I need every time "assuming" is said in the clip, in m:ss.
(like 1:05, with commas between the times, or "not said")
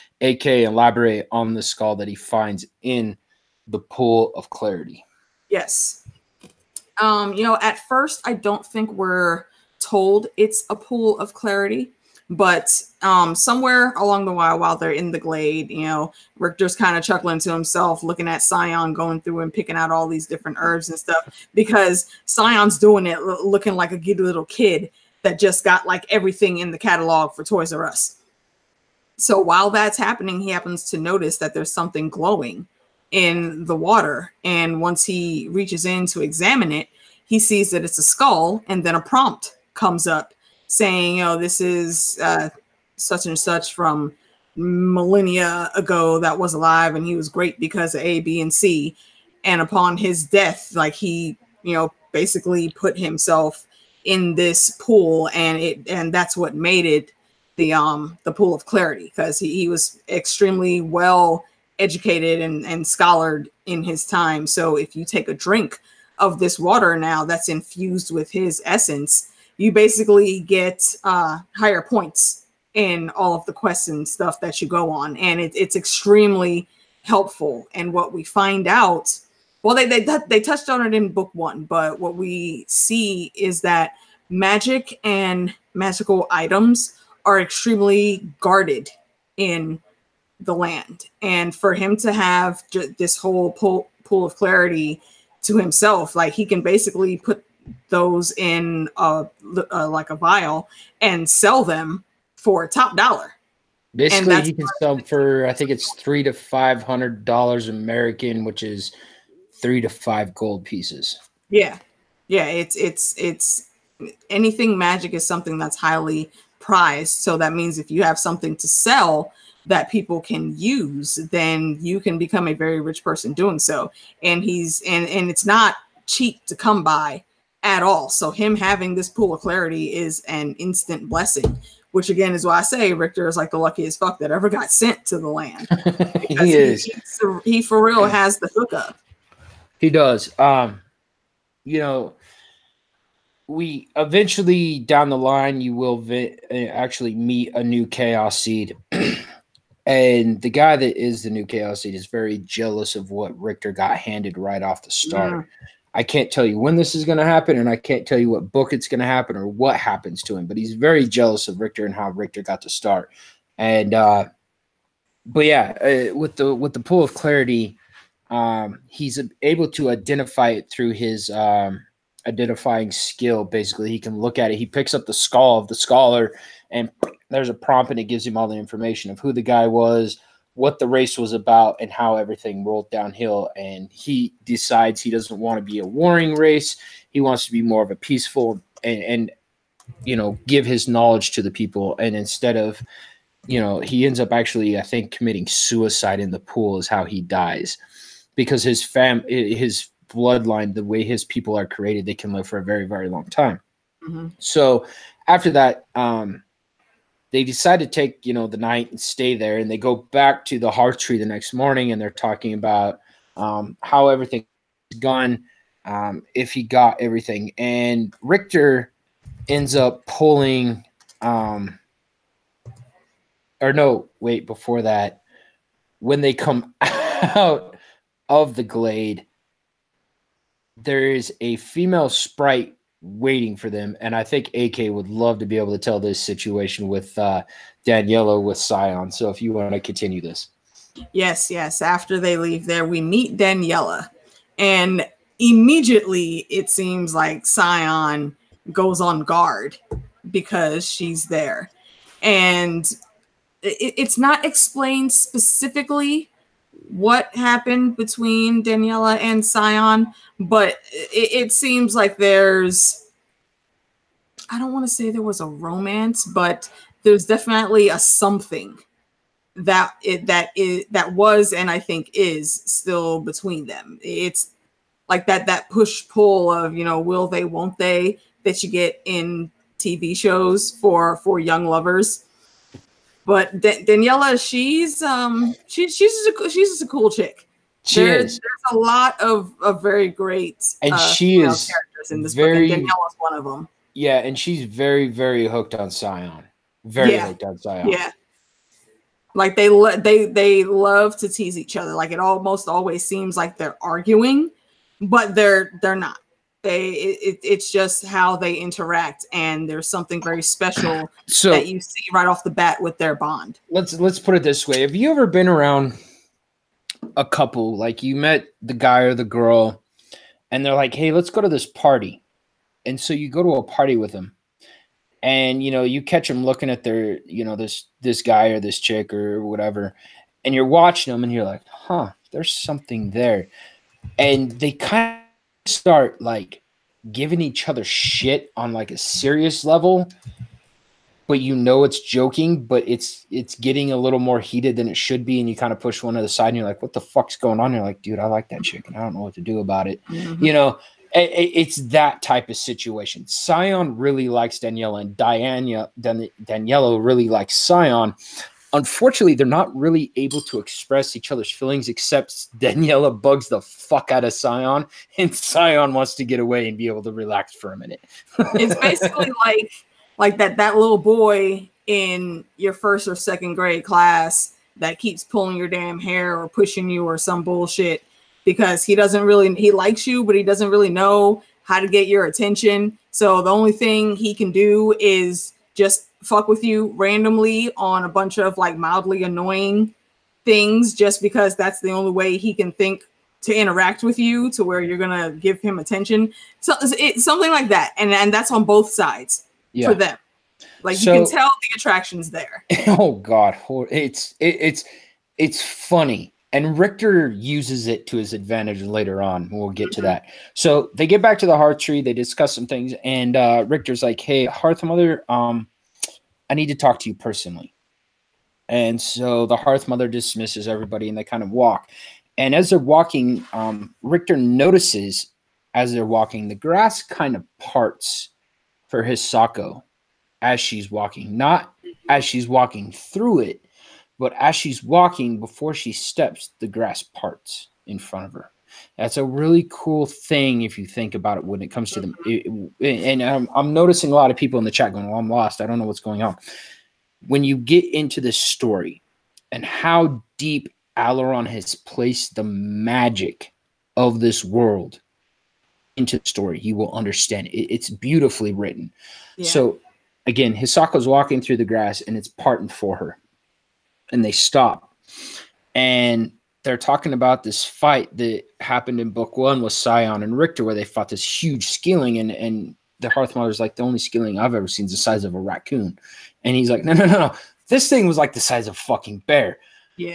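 not said.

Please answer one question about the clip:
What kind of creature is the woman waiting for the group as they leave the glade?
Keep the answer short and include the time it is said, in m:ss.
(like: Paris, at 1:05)
sprite, at 3:52.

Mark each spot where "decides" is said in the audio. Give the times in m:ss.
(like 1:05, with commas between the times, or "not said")
3:04, 3:27.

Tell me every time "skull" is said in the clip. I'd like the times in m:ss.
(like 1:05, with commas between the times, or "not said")
0:01, 0:38, 2:55.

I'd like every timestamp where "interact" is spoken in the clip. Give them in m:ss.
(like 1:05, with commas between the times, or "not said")
5:08, 6:33.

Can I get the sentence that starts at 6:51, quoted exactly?
They discuss some things, and uh, Richter's like, "Hey, Hearth Mother, um, I need to talk to you personally.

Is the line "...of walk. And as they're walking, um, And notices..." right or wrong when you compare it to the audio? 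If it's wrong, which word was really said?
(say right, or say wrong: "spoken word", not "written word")
wrong: "Richter", not "And".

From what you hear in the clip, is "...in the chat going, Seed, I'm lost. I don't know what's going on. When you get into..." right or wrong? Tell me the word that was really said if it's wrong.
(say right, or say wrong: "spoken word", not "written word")
wrong: "Well", not "Seed".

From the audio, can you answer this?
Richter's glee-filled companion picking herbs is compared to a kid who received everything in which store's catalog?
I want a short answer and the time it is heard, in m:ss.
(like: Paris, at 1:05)
Toys R Us, at 0:27.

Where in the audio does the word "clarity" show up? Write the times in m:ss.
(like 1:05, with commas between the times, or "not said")
0:04, 0:11, 0:58, 1:34, 2:09, 2:47.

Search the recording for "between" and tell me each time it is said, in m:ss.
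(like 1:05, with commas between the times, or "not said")
4:17, 4:33.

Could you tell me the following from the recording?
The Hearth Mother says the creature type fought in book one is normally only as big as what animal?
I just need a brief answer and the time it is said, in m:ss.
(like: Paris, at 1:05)
raccoon, at 7:55.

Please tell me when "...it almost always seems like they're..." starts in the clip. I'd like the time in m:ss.
5:02.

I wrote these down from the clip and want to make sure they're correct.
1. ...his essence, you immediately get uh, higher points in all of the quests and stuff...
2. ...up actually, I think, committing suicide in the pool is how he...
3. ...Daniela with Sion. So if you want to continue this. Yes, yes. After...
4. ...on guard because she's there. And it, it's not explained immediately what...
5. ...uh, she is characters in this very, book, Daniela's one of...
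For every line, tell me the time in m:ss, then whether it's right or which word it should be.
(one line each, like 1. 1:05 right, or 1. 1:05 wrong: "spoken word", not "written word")
1. 1:08 wrong: "basically", not "immediately"
2. 3:14 right
3. 3:57 right
4. 4:08 wrong: "specifically", not "immediately"
5. 4:50 right.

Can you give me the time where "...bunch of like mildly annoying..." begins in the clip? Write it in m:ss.
6:28.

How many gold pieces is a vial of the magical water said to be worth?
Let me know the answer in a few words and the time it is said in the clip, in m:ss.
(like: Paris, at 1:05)
3 to 5, at 1:49.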